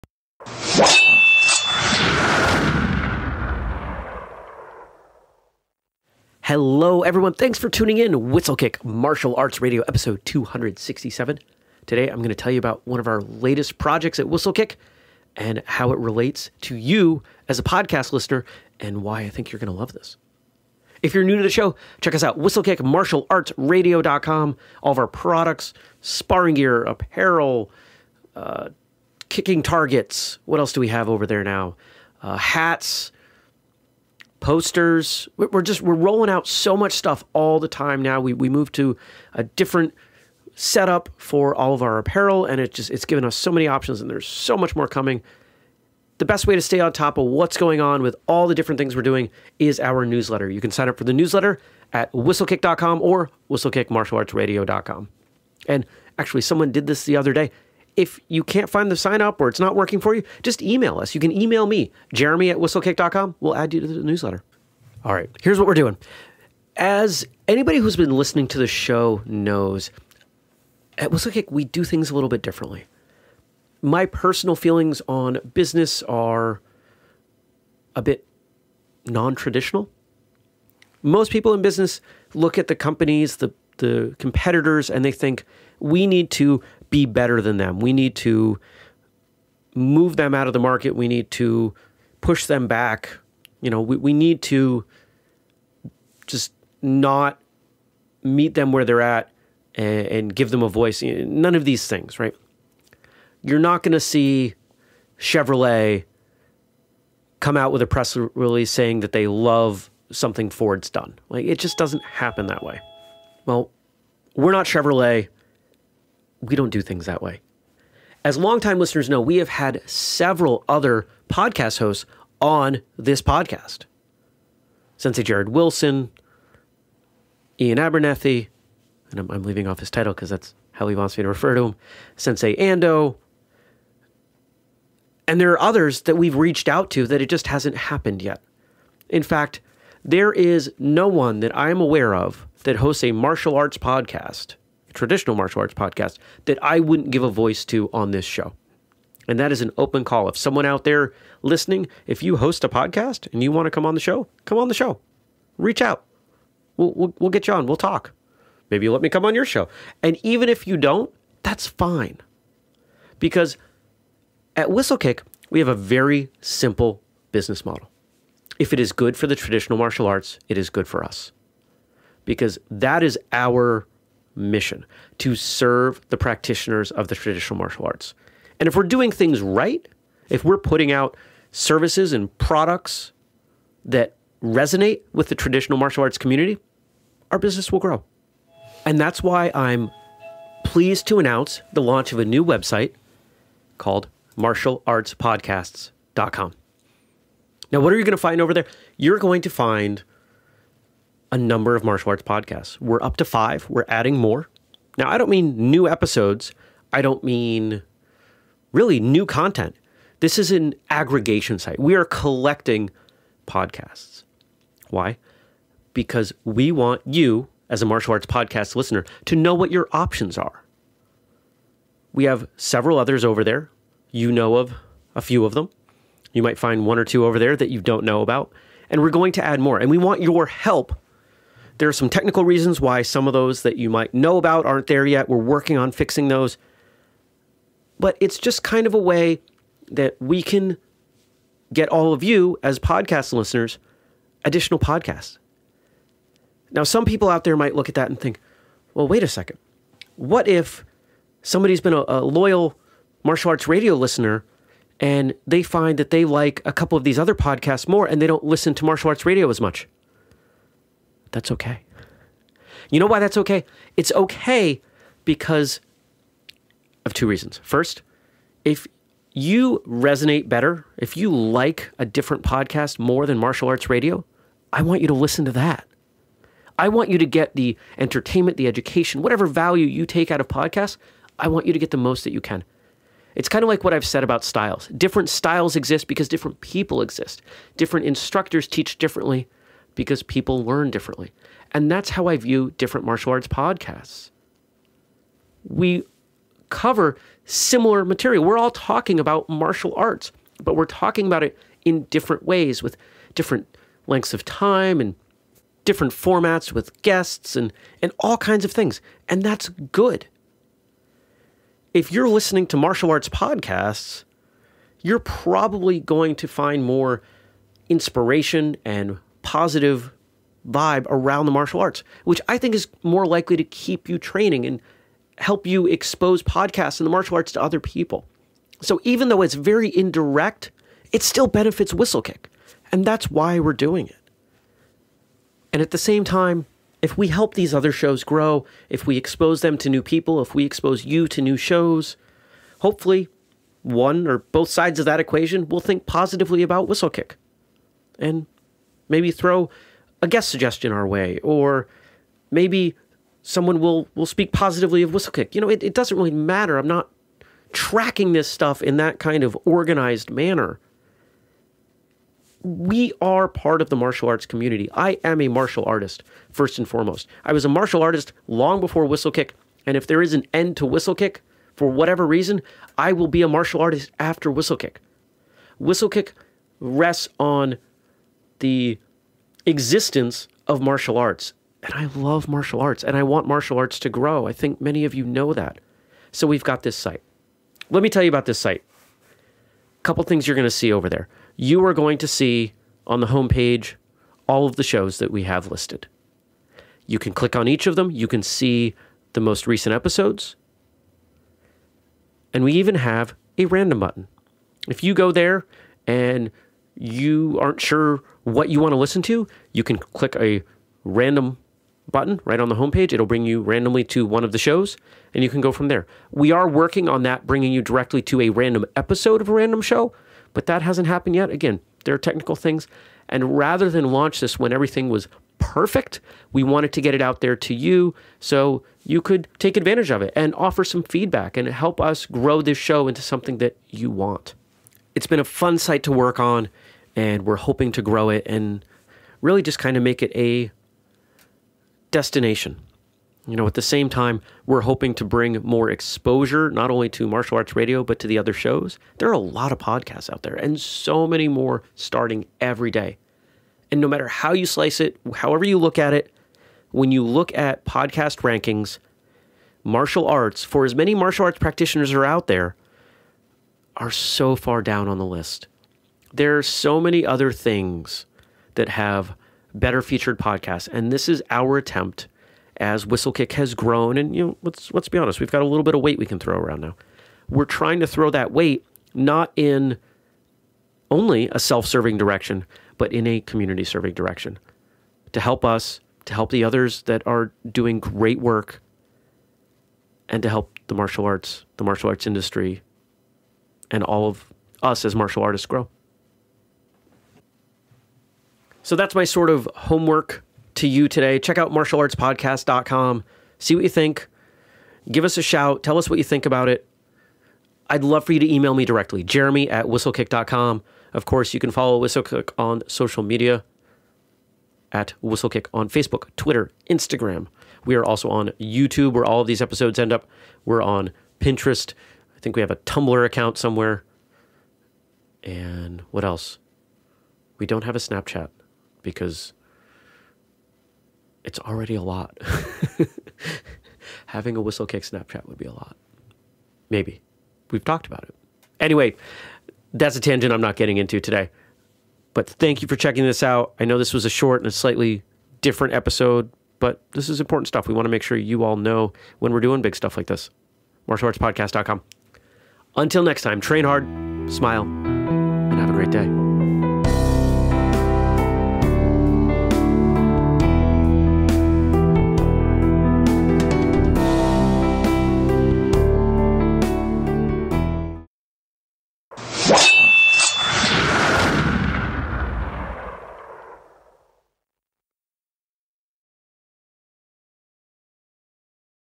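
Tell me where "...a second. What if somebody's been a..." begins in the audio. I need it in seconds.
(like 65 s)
249 s.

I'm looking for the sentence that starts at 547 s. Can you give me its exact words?
We want to make sure you all know when we're doing big stuff like this.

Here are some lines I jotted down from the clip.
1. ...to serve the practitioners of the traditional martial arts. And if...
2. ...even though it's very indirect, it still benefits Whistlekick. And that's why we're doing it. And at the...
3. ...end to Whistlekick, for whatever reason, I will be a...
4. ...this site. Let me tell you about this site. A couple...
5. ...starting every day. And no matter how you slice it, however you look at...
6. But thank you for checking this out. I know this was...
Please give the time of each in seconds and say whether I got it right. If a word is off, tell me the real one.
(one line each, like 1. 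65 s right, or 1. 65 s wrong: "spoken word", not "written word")
1. 175 s right
2. 329 s right
3. 370 s right
4. 386 s right
5. 451 s right
6. 542 s right.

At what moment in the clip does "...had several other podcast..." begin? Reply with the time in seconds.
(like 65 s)
119 s.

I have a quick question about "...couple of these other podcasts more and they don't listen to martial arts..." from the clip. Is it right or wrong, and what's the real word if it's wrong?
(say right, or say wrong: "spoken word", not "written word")
right.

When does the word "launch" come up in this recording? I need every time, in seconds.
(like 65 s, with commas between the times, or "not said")
191 s, 424 s.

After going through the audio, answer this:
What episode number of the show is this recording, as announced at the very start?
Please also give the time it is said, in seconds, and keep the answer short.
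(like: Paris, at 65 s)
267, at 9 s.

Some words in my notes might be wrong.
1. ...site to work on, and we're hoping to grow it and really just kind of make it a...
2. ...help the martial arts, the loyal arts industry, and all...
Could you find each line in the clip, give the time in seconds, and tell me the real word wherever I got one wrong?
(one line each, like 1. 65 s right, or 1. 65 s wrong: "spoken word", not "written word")
1. 435 s right
2. 490 s wrong: "martial", not "loyal".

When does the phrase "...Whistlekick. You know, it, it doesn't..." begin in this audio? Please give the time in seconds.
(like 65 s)
355 s.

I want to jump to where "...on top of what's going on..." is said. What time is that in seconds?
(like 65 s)
46 s.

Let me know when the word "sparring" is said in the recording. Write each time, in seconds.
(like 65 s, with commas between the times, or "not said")
26 s.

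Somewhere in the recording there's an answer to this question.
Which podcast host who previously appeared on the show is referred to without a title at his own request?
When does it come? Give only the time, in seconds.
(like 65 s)
127 s.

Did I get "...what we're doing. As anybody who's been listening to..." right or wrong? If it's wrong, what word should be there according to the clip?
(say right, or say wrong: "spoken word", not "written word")
right.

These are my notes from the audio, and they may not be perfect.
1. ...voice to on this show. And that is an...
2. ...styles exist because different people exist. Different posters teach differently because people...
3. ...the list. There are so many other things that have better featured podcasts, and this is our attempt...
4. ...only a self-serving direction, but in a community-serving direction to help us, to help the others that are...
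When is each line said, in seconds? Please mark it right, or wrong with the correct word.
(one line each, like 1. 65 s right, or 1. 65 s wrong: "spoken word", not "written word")
1. 147 s right
2. 285 s wrong: "instructors", not "posters"
3. 465 s right
4. 481 s right.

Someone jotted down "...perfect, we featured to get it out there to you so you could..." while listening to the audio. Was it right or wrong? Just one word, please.
wrong.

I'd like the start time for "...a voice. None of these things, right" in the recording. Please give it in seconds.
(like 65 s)
100 s.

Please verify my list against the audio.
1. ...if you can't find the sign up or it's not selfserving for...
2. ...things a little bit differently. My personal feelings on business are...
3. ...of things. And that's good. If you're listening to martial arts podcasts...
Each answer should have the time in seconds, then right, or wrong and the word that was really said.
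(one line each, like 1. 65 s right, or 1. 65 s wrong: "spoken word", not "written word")
1. 57 s wrong: "working", not "selfserving"
2. 71 s right
3. 308 s right.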